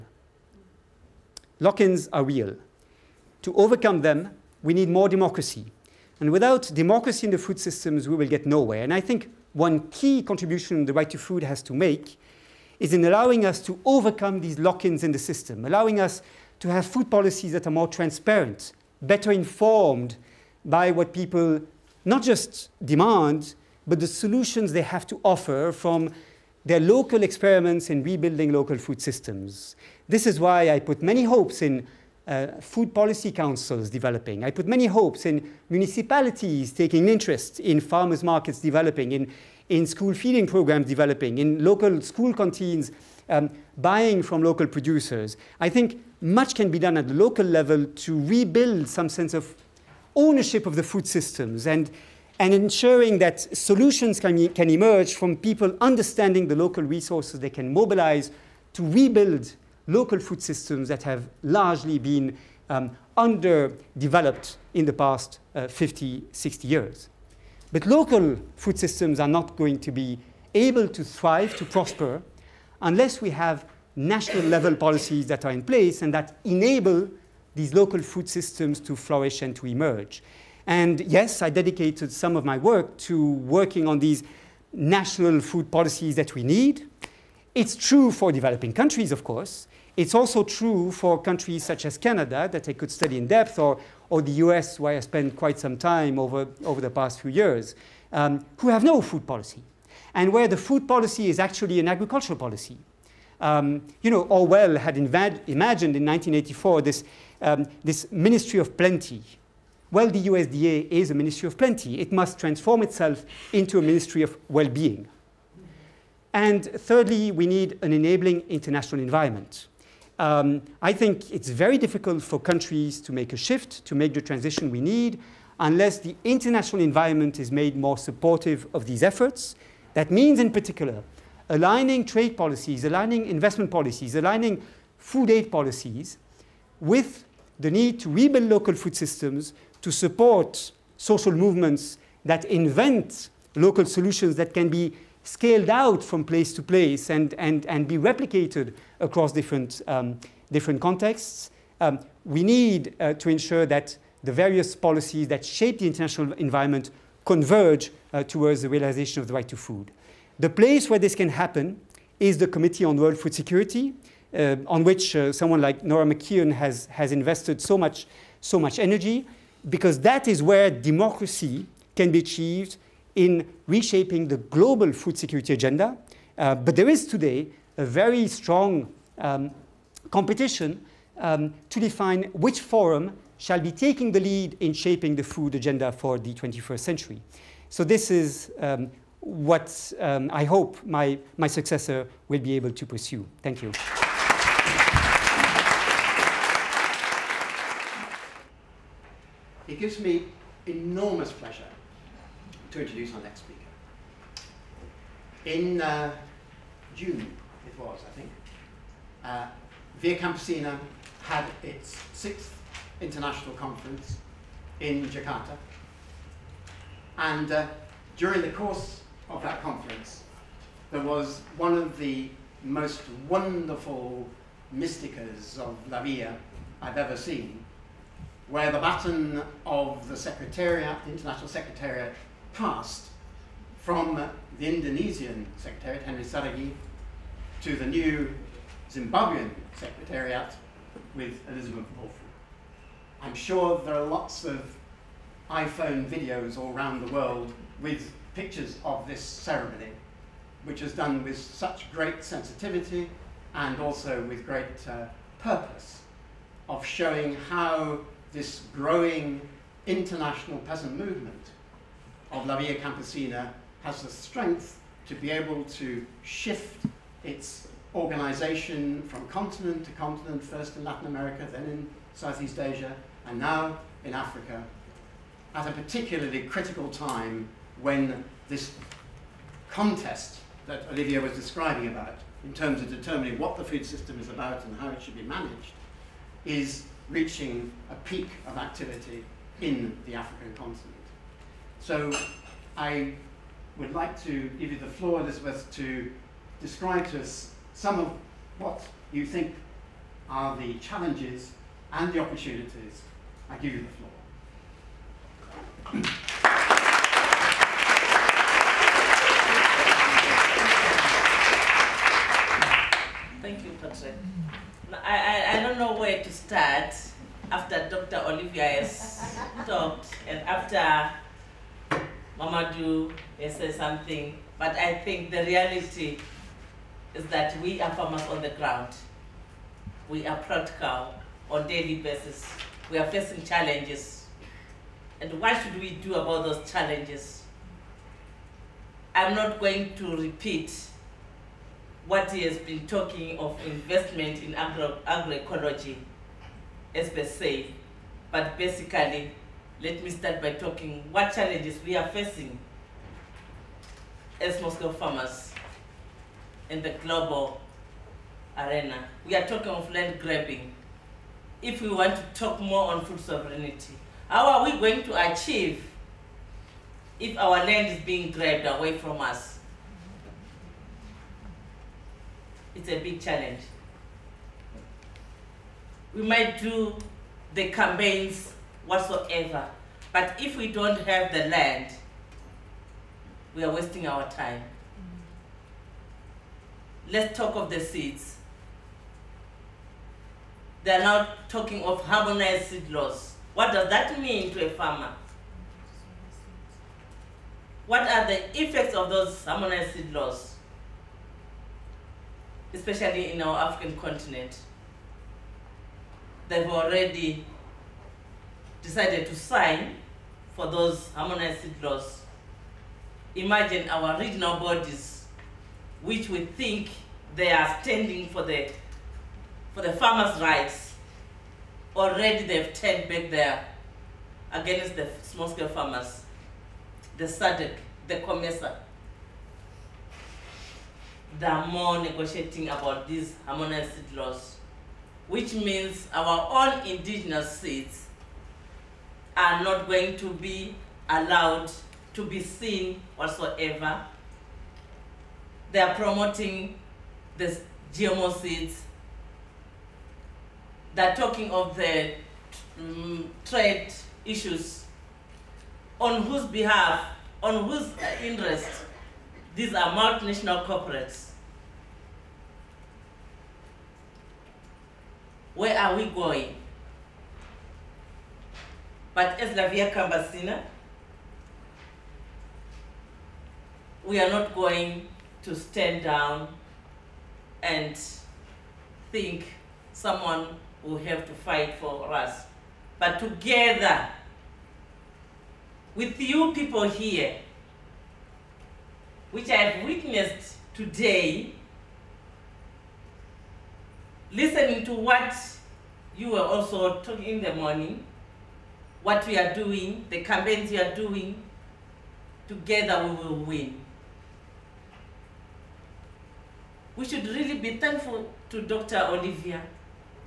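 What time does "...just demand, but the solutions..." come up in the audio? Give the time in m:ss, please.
0:22.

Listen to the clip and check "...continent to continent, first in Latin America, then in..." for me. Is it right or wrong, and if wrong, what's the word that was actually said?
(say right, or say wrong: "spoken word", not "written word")
right.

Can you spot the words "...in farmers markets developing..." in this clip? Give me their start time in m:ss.
0:37.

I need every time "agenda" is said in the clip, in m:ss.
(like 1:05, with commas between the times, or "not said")
2:55, 3:05.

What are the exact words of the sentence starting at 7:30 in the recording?
They're talking of the um, trade issues.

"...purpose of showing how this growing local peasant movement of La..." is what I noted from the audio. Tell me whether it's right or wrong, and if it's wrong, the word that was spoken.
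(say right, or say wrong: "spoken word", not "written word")
wrong: "international", not "local".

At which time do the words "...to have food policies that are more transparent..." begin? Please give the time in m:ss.
0:16.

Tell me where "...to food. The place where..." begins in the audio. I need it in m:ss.
2:39.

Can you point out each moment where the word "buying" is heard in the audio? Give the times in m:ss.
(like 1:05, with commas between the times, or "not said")
0:43.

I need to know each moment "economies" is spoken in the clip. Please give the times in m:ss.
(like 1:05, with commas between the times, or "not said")
not said.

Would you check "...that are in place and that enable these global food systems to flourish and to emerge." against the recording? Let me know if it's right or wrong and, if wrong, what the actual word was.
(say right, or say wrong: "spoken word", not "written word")
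wrong: "local", not "global".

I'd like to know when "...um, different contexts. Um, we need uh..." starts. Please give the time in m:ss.
2:29.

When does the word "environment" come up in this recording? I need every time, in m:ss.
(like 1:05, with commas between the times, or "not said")
1:59, 2:06, 2:36.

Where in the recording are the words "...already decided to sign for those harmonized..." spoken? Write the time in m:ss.
6:46.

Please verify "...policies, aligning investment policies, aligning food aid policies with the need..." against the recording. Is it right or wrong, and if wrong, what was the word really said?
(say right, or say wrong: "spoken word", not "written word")
right.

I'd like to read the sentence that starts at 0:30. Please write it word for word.
This is why I put many hopes in uh, food policy councils developing.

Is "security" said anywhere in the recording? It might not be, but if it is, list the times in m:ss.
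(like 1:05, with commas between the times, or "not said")
2:43, 2:55.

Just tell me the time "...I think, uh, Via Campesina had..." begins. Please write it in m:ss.
3:28.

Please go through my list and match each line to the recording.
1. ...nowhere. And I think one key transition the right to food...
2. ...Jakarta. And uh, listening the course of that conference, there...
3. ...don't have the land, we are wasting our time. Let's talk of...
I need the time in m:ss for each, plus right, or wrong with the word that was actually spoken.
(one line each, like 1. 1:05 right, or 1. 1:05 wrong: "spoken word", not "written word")
1. 0:08 wrong: "contribution", not "transition"
2. 3:35 wrong: "during", not "listening"
3. 6:20 right.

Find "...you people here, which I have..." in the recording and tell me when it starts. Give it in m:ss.
8:06.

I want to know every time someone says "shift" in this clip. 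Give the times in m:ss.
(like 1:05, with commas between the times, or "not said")
2:03, 4:26.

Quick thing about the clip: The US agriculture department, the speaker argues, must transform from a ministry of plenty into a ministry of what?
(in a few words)
well-being.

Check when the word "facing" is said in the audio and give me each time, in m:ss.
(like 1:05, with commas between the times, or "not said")
5:33, 5:52.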